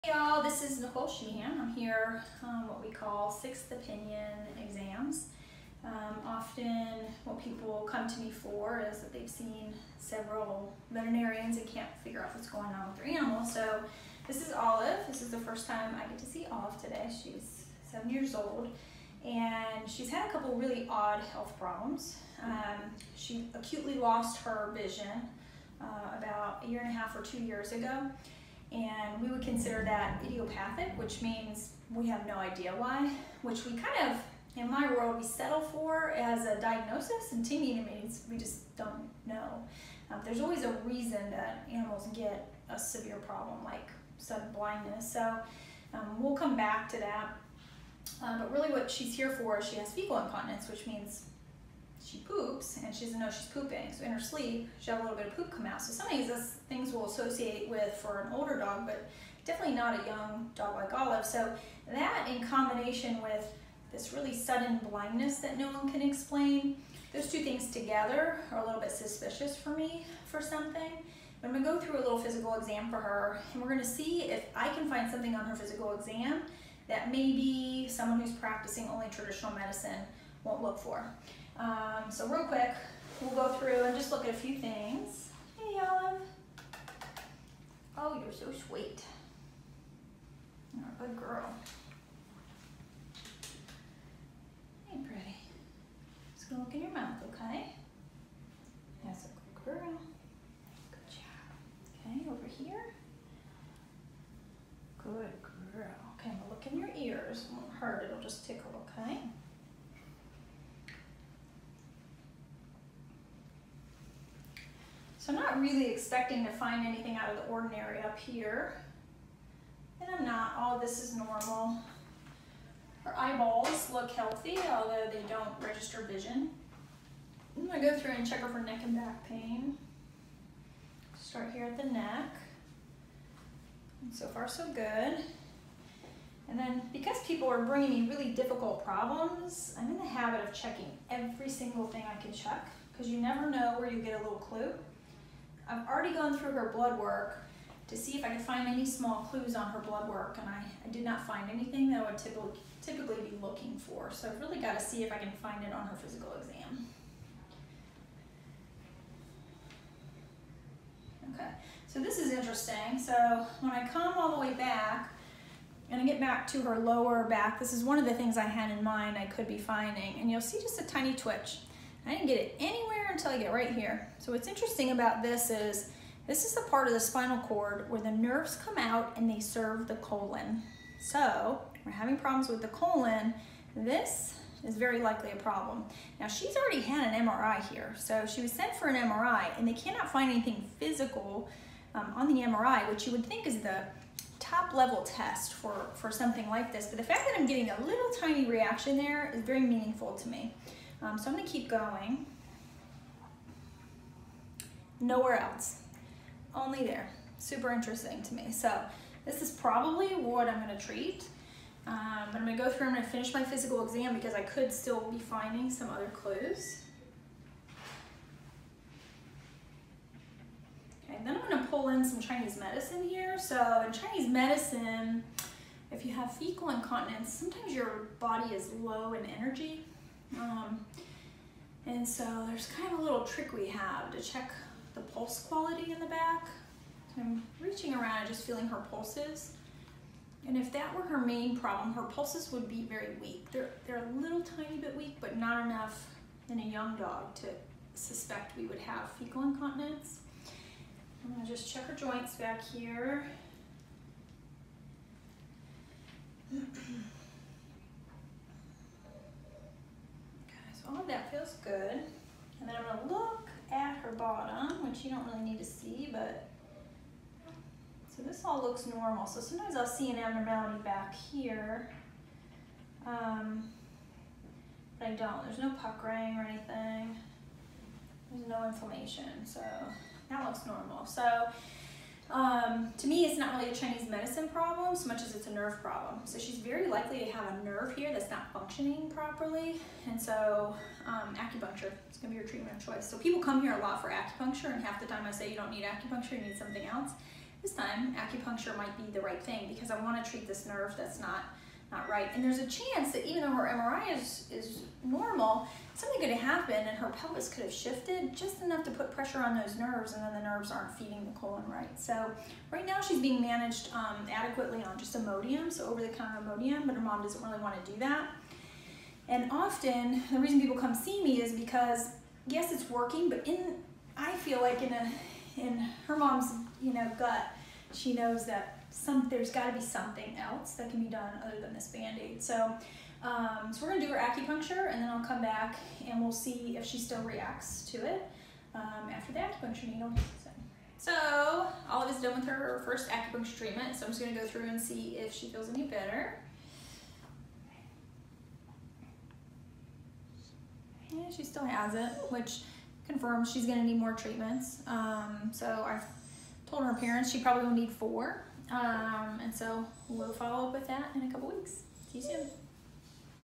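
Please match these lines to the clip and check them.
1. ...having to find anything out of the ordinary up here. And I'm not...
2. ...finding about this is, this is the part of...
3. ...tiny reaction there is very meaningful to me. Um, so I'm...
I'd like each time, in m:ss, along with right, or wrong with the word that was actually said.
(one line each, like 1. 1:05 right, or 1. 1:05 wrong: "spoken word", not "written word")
1. 1:55 wrong: "expecting", not "having"
2. 2:54 wrong: "interesting", not "finding"
3. 3:18 right.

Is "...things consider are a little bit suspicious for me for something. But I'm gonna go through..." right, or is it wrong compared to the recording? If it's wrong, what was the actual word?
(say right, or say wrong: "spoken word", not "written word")
wrong: "together", not "consider".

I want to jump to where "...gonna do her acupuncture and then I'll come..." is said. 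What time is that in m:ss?
5:33.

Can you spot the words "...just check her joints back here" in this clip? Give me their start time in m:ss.
4:11.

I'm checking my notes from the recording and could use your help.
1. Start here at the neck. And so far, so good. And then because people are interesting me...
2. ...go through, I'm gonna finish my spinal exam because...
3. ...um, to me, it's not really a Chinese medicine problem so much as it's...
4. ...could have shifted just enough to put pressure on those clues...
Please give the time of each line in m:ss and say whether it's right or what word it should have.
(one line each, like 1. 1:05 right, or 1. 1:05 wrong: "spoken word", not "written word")
1. 2:11 wrong: "bringing", not "interesting"
2. 3:32 wrong: "physical", not "spinal"
3. 4:42 right
4. 5:07 wrong: "nerves", not "clues".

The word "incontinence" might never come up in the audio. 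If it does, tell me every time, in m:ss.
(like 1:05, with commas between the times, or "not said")
0:50, 3:46, 4:09.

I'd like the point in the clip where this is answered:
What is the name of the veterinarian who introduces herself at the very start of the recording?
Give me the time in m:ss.
0:00.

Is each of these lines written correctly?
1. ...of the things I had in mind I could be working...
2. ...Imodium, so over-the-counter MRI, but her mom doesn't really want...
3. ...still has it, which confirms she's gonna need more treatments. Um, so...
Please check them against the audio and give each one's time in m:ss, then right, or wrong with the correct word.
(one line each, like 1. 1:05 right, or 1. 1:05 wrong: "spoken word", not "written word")
1. 2:47 wrong: "finding", not "working"
2. 5:15 wrong: "Imodium", not "MRI"
3. 5:51 right.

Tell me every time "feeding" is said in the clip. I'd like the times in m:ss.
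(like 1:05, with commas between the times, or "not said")
5:10.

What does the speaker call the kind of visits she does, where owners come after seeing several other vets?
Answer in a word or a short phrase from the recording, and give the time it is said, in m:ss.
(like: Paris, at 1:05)
sixth opinion exams, at 0:03.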